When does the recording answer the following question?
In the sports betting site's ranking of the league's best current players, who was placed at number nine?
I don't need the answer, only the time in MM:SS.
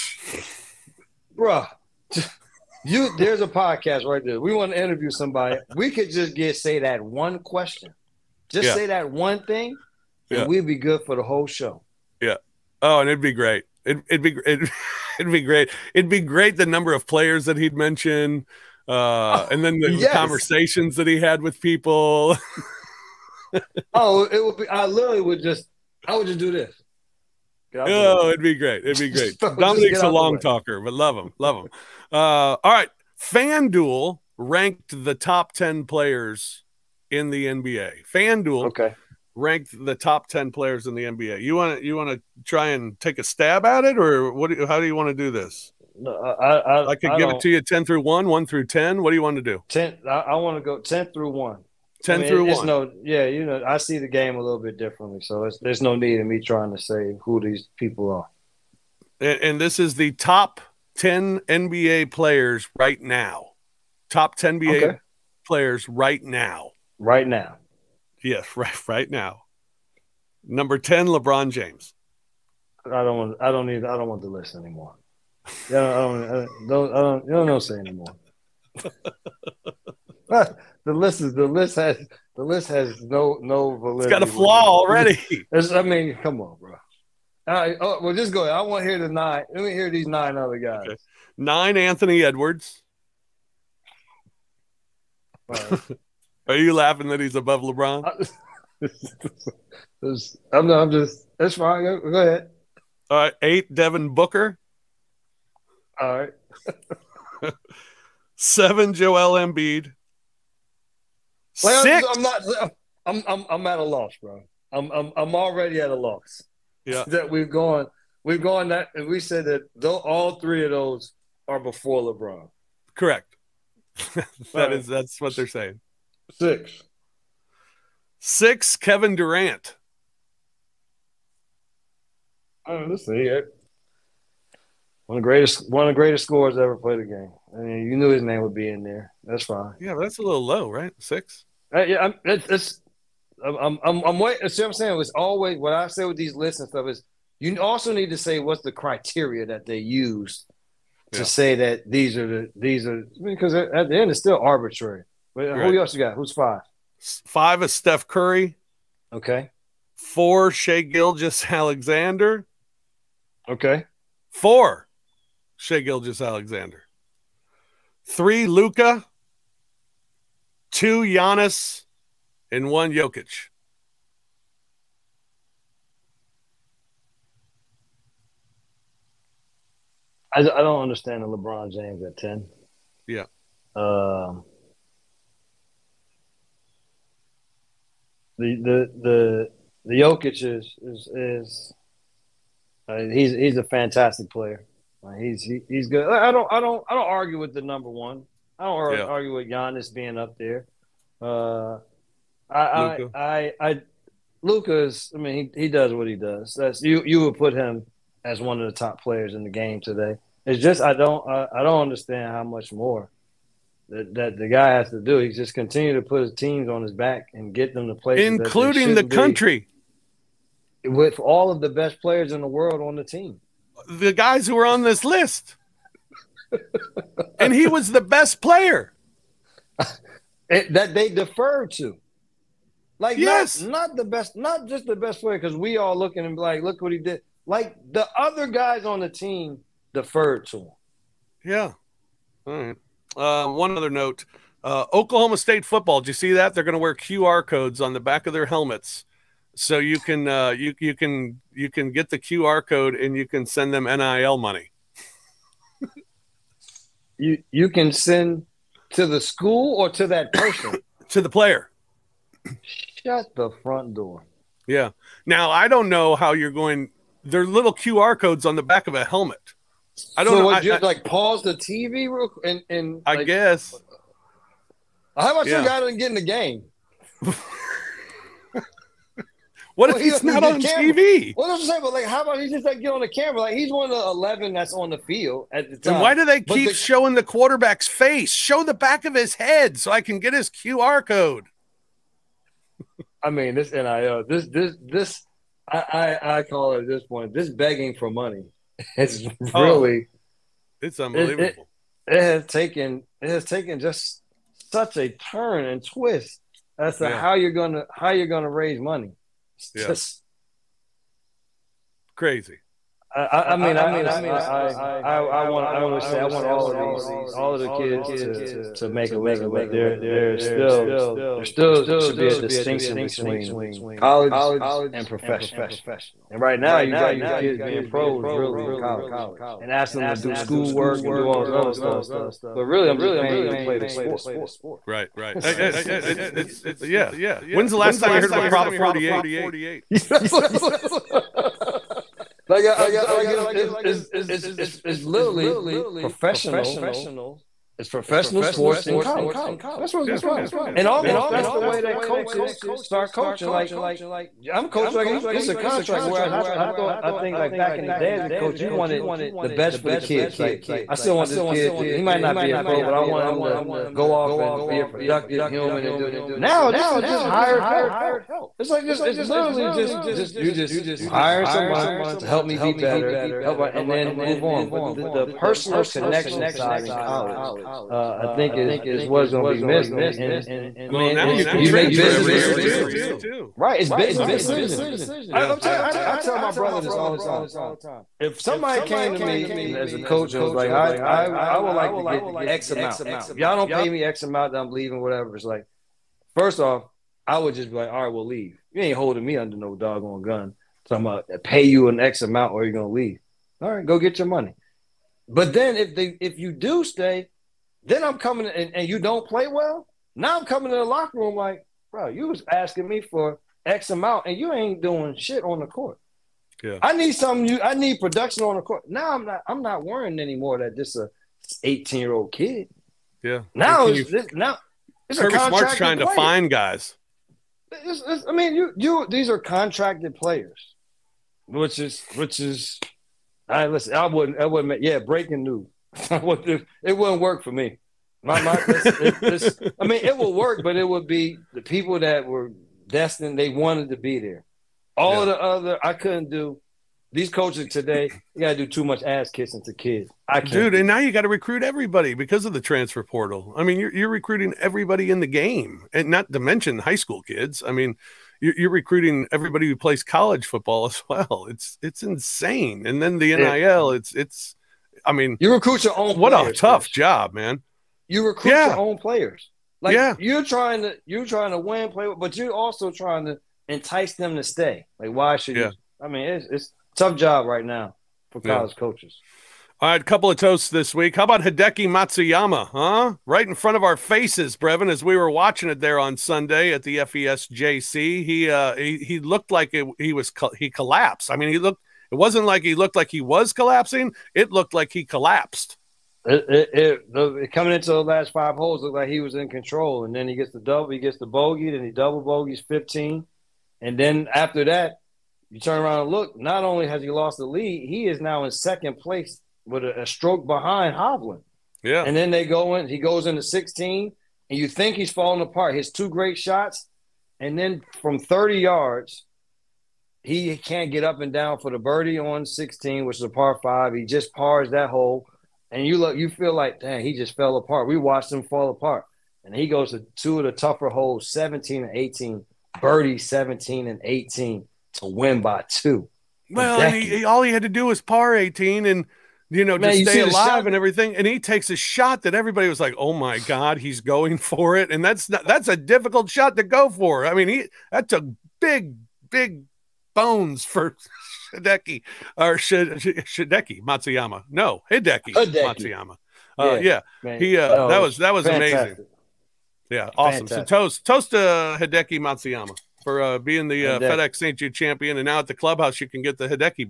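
01:31.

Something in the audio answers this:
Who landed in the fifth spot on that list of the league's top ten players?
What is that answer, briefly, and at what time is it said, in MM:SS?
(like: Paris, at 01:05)
Steph Curry, at 02:37.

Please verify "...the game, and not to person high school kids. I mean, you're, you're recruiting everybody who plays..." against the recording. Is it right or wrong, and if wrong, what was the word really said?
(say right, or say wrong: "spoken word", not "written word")
wrong: "mention", not "person".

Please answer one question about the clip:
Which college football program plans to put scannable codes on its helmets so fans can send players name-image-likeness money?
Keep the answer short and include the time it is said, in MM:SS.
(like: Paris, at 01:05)
Oklahoma State, at 04:04.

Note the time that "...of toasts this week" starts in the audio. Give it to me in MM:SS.
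08:00.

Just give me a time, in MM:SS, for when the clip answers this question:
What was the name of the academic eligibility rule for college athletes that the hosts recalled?
05:38.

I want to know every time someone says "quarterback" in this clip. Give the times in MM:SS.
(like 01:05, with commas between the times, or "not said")
04:47.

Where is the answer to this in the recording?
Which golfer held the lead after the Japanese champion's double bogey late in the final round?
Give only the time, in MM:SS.
08:30.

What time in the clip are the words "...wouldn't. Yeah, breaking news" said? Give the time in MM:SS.
07:14.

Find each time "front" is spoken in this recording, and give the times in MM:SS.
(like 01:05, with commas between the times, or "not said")
04:23, 08:03.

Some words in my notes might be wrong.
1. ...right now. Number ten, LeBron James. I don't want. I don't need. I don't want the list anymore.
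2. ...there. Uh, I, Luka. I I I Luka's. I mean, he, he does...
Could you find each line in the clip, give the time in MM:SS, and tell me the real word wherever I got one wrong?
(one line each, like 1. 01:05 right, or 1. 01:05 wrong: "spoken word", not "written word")
1. 01:08 right
2. 03:20 right.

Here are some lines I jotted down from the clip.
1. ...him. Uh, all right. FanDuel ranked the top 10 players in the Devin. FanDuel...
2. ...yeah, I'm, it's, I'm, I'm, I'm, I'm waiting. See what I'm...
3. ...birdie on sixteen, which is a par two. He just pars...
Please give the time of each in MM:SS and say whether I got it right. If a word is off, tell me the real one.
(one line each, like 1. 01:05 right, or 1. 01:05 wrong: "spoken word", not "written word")
1. 00:31 wrong: "NBA", not "Devin"
2. 02:21 right
3. 08:41 wrong: "five", not "two".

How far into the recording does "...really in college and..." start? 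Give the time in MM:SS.
05:28.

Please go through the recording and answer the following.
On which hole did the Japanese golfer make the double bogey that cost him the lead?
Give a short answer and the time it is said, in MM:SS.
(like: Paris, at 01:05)
15, at 08:22.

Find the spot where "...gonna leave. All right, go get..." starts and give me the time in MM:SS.
06:42.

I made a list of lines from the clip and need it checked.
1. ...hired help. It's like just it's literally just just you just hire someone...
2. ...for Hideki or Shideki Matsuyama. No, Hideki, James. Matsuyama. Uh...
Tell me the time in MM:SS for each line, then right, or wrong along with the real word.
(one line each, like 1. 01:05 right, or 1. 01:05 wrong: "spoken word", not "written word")
1. 06:07 right
2. 09:10 wrong: "Hideki", not "James".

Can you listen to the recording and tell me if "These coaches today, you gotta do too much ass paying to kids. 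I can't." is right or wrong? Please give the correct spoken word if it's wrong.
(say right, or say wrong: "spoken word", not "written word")
wrong: "kissing", not "paying".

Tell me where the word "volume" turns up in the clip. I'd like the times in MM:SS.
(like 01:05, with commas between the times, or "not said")
not said.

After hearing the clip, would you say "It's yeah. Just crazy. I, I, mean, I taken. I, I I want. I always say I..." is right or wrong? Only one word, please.
wrong.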